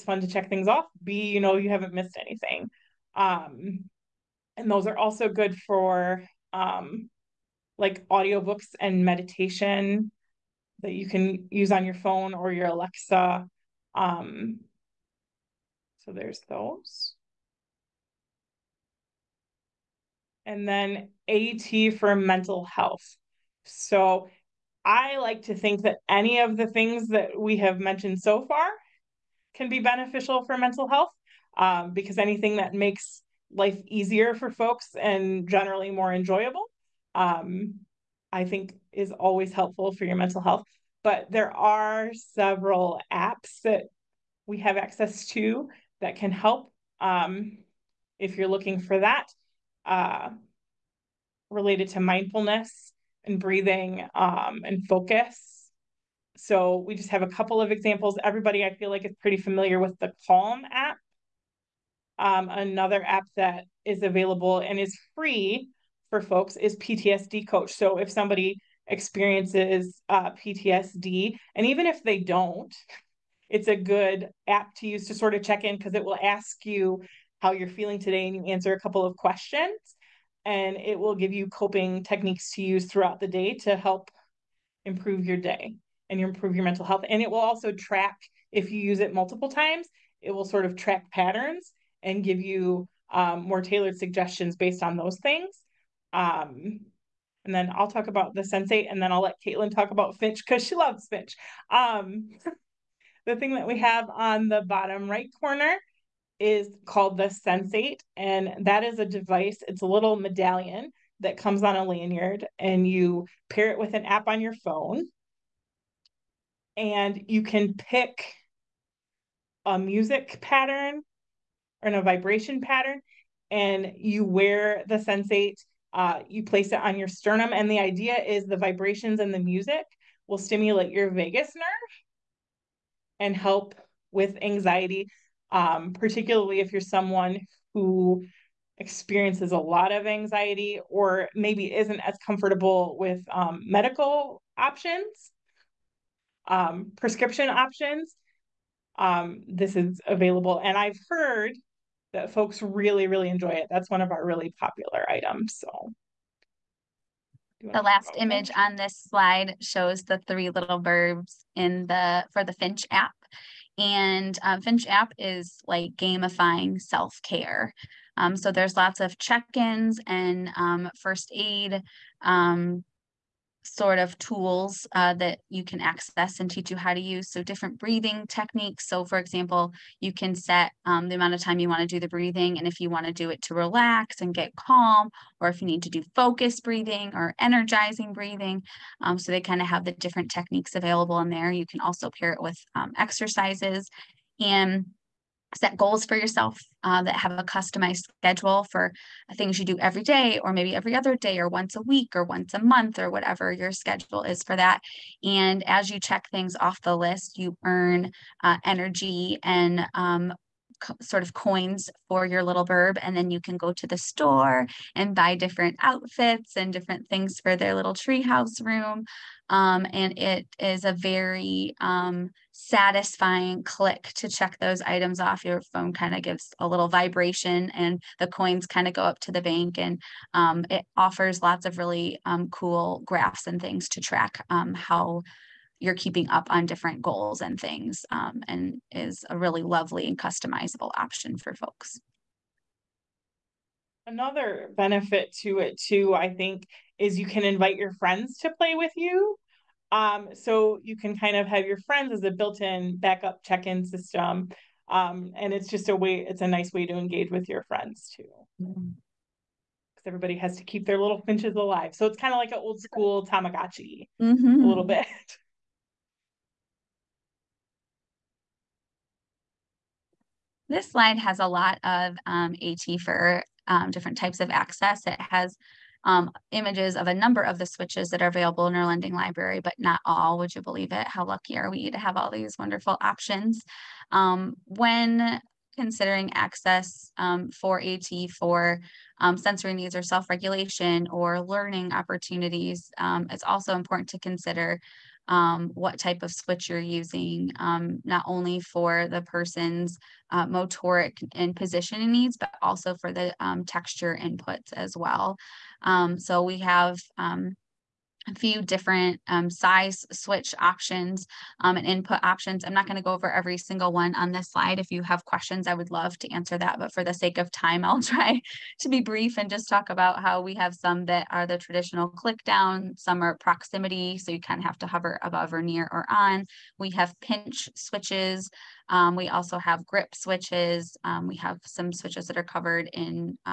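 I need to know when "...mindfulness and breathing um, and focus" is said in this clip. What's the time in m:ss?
0:51.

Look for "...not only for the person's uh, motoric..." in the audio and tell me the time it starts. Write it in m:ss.
4:58.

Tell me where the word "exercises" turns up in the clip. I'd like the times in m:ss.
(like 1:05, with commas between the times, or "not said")
3:12.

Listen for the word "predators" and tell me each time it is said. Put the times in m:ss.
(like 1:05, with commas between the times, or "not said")
not said.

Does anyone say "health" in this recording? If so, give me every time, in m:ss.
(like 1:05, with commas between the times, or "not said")
0:22, 0:30, 0:40, 1:26.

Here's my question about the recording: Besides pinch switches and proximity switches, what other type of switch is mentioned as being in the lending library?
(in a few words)
grip switches.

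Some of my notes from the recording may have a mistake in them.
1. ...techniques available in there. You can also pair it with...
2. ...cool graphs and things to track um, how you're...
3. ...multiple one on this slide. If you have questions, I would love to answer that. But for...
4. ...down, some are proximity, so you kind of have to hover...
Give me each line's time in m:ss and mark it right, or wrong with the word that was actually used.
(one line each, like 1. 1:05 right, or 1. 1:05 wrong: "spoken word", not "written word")
1. 3:10 right
2. 3:52 right
3. 5:13 wrong: "single", not "multiple"
4. 5:22 right.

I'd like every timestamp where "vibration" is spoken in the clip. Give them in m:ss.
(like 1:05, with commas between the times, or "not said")
2:02, 2:08, 3:46.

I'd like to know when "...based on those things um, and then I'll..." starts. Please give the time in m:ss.
1:34.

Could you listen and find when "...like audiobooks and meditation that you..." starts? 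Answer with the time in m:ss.
0:07.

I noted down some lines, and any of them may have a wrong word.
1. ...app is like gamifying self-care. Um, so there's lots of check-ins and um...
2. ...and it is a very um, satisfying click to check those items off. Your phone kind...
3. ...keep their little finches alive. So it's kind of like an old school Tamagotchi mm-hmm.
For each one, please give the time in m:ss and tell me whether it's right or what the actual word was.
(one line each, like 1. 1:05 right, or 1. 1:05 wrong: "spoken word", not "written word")
1. 2:44 right
2. 3:39 right
3. 4:20 right.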